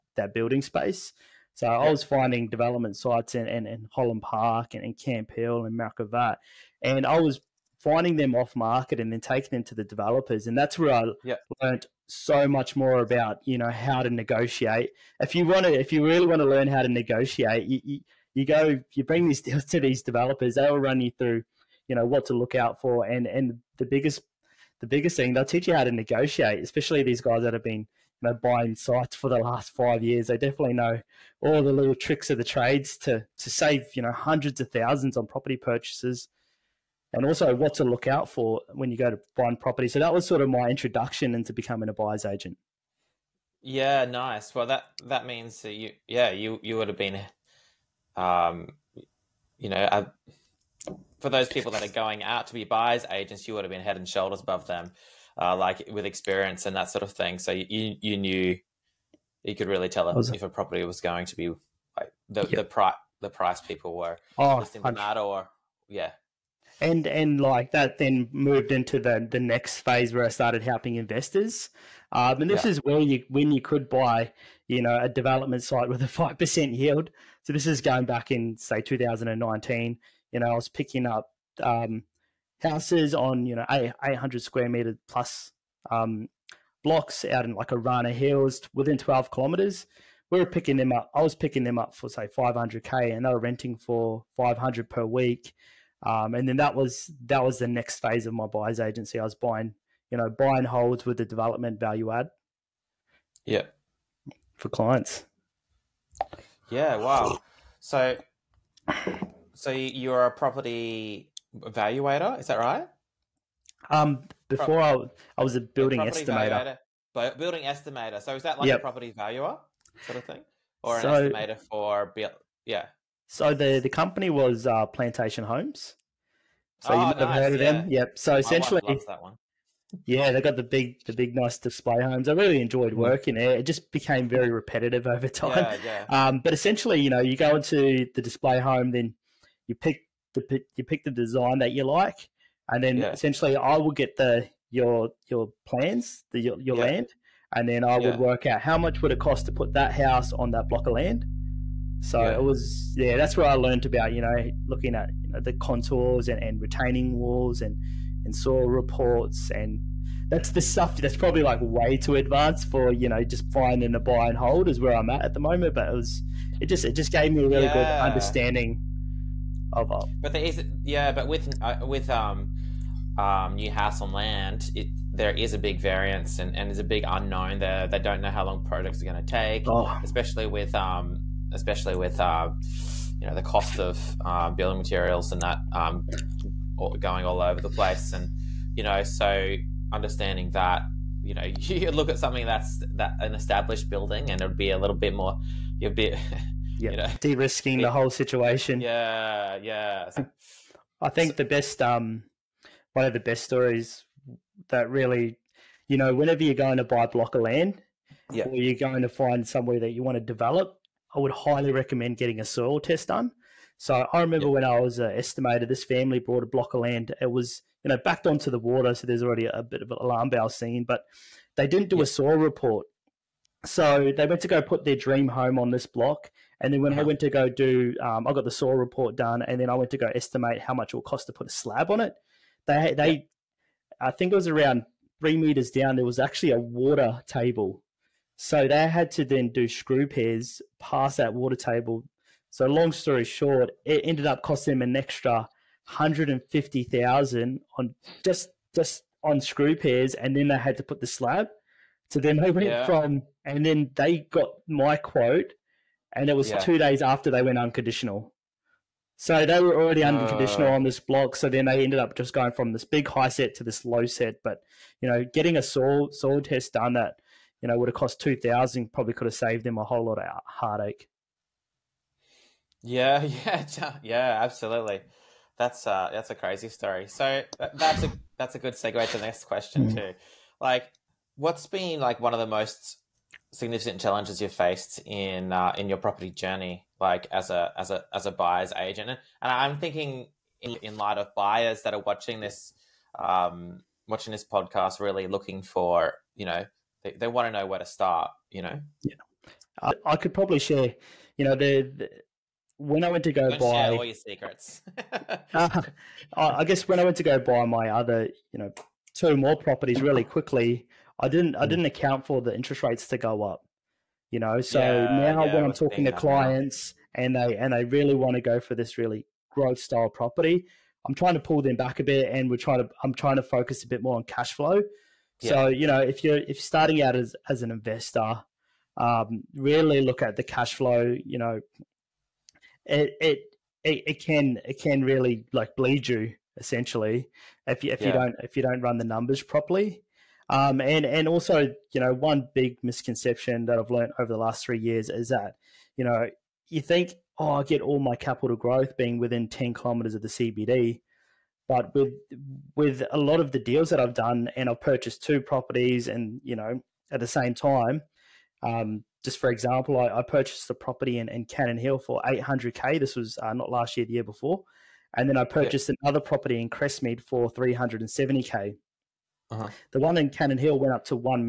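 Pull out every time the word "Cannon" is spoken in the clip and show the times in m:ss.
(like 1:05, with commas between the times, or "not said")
6:01, 6:10.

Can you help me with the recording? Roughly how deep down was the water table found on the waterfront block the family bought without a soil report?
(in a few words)
3 meters.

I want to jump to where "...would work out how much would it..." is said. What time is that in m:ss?
2:27.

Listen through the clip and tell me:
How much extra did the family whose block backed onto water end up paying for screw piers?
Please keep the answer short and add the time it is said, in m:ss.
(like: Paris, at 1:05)
$150,000, at 4:04.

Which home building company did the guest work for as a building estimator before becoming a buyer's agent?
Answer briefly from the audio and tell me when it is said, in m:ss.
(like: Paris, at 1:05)
Plantation Homes, at 2:04.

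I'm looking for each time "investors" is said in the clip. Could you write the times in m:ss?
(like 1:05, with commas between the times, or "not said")
1:10, 5:27.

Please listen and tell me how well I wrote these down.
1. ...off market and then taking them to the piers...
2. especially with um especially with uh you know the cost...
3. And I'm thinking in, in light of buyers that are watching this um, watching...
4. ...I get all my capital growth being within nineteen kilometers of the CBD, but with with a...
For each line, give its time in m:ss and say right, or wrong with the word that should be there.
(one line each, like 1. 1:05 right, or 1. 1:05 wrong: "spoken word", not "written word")
1. 0:08 wrong: "developers", not "piers"
2. 3:00 right
3. 4:49 right
4. 5:47 wrong: "ten", not "nineteen".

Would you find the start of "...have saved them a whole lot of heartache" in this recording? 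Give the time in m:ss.
4:29.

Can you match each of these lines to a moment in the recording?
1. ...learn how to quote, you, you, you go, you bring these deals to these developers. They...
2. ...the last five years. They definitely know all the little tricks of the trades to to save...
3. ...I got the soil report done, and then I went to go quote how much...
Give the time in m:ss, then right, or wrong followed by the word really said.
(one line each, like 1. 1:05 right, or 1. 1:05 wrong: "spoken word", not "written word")
1. 0:16 wrong: "negotiate", not "quote"
2. 0:29 right
3. 3:48 wrong: "estimate", not "quote".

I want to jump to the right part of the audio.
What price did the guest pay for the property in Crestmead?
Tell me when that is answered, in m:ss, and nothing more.
6:07.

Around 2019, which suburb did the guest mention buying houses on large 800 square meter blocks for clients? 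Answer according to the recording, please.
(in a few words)
Arana Hills.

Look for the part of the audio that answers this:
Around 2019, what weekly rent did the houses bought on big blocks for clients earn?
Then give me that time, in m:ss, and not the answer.
1:34.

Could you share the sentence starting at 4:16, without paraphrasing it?
two days after they went unconditional.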